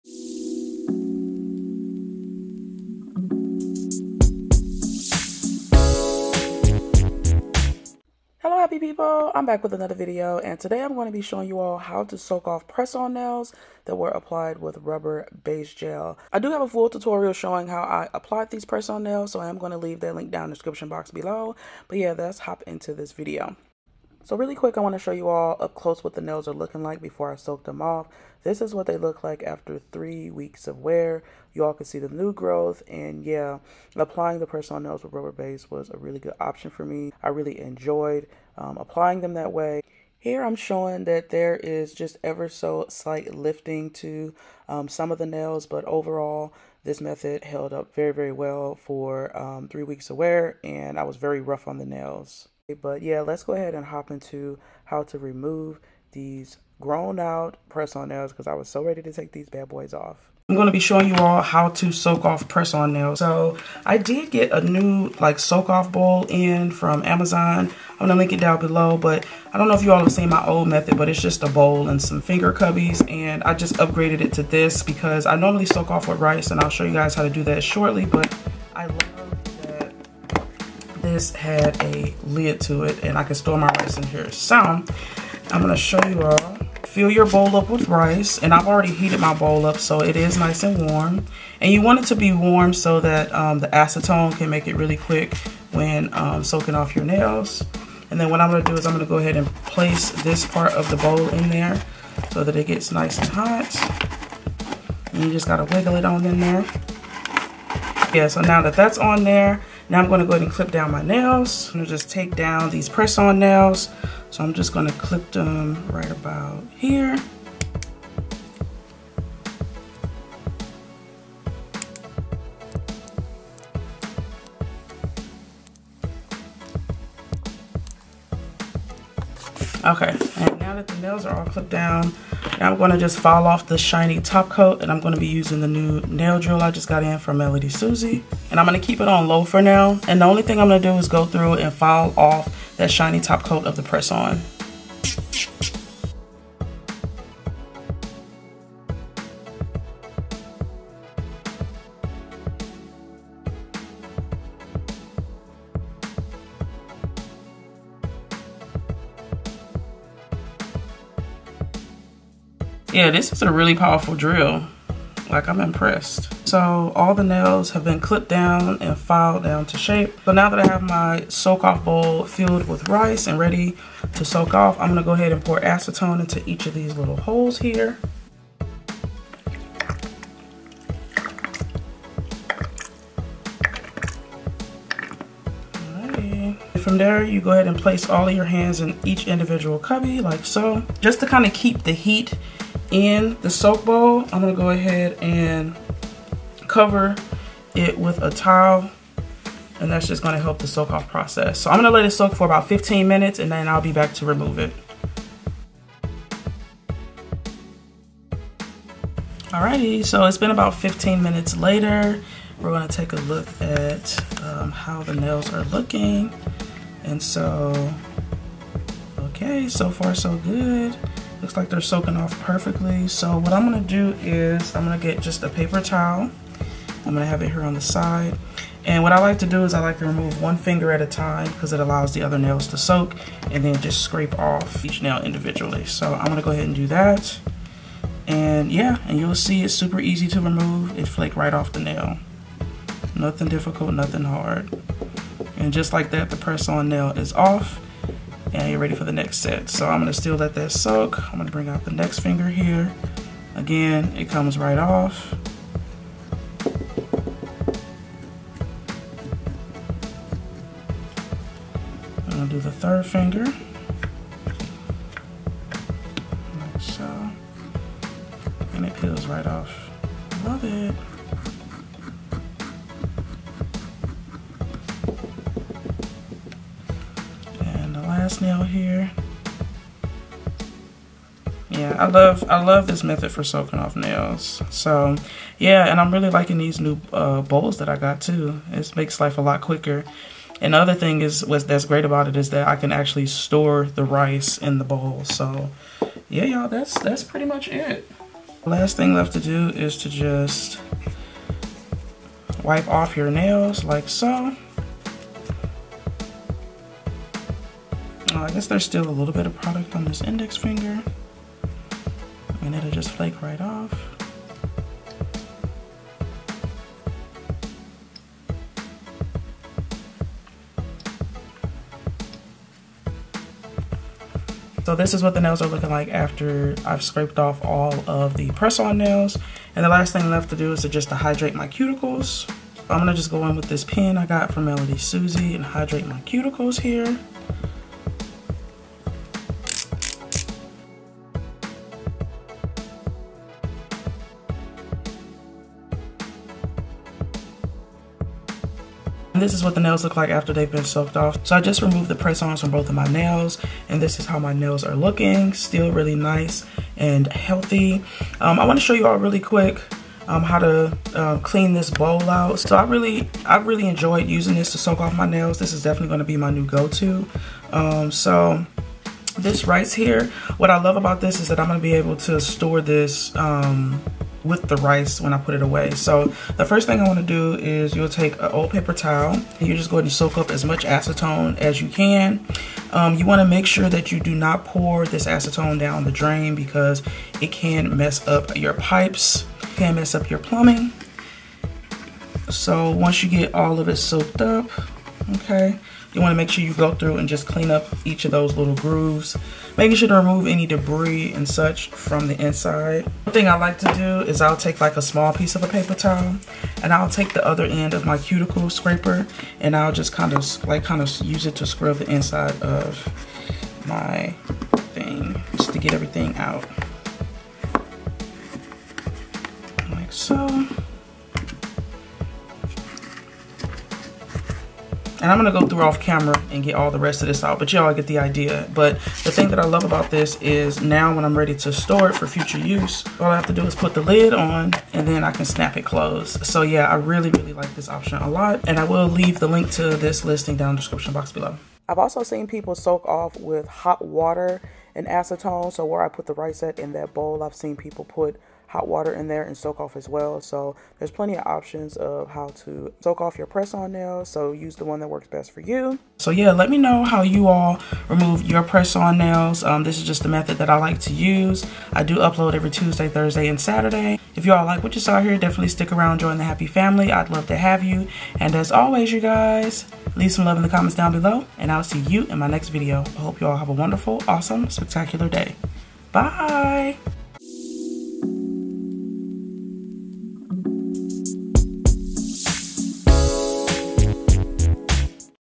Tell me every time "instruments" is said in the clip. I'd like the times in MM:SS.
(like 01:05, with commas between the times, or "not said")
not said.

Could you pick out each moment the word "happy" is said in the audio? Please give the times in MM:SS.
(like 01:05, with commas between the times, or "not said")
00:08, 07:46.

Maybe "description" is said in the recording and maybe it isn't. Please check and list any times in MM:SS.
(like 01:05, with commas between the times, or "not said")
00:20, 07:20.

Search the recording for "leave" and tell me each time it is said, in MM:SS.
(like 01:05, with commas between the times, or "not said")
00:19, 07:19, 07:50.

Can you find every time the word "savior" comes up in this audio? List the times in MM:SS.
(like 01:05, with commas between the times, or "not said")
not said.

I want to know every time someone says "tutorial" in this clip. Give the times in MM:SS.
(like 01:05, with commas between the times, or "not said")
00:16.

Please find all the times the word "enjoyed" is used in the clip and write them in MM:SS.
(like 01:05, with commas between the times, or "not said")
00:37, 06:03.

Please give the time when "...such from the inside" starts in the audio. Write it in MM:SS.
06:41.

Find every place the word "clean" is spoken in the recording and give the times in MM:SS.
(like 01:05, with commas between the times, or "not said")
06:01, 06:37.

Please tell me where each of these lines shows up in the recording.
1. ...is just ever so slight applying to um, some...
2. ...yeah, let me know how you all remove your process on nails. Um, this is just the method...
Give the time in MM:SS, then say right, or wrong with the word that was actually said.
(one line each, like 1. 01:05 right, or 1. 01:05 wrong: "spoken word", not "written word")
1. 00:41 wrong: "lifting", not "applying"
2. 07:36 wrong: "press", not "process".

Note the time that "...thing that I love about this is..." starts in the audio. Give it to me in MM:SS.
07:09.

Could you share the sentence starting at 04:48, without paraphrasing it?
It makes life a lot quicker.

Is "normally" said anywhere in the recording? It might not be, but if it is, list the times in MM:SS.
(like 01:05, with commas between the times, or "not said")
01:15.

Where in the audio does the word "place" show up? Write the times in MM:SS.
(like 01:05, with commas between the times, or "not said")
01:39, 03:07.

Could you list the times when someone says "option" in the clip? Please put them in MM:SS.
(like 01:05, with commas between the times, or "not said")
00:36, 07:17, 07:31.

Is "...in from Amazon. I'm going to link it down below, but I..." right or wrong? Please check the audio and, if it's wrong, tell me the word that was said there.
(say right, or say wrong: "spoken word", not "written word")
right.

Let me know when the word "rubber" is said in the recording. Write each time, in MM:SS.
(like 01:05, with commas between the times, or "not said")
00:14, 00:35.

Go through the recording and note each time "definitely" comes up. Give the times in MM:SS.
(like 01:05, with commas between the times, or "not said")
06:05, 07:45.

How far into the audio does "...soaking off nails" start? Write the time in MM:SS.
04:43.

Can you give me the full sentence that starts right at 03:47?
I'm gonna have it here on the side.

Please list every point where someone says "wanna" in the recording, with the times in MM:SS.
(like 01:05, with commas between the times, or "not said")
06:36.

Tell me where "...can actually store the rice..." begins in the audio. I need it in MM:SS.
04:52.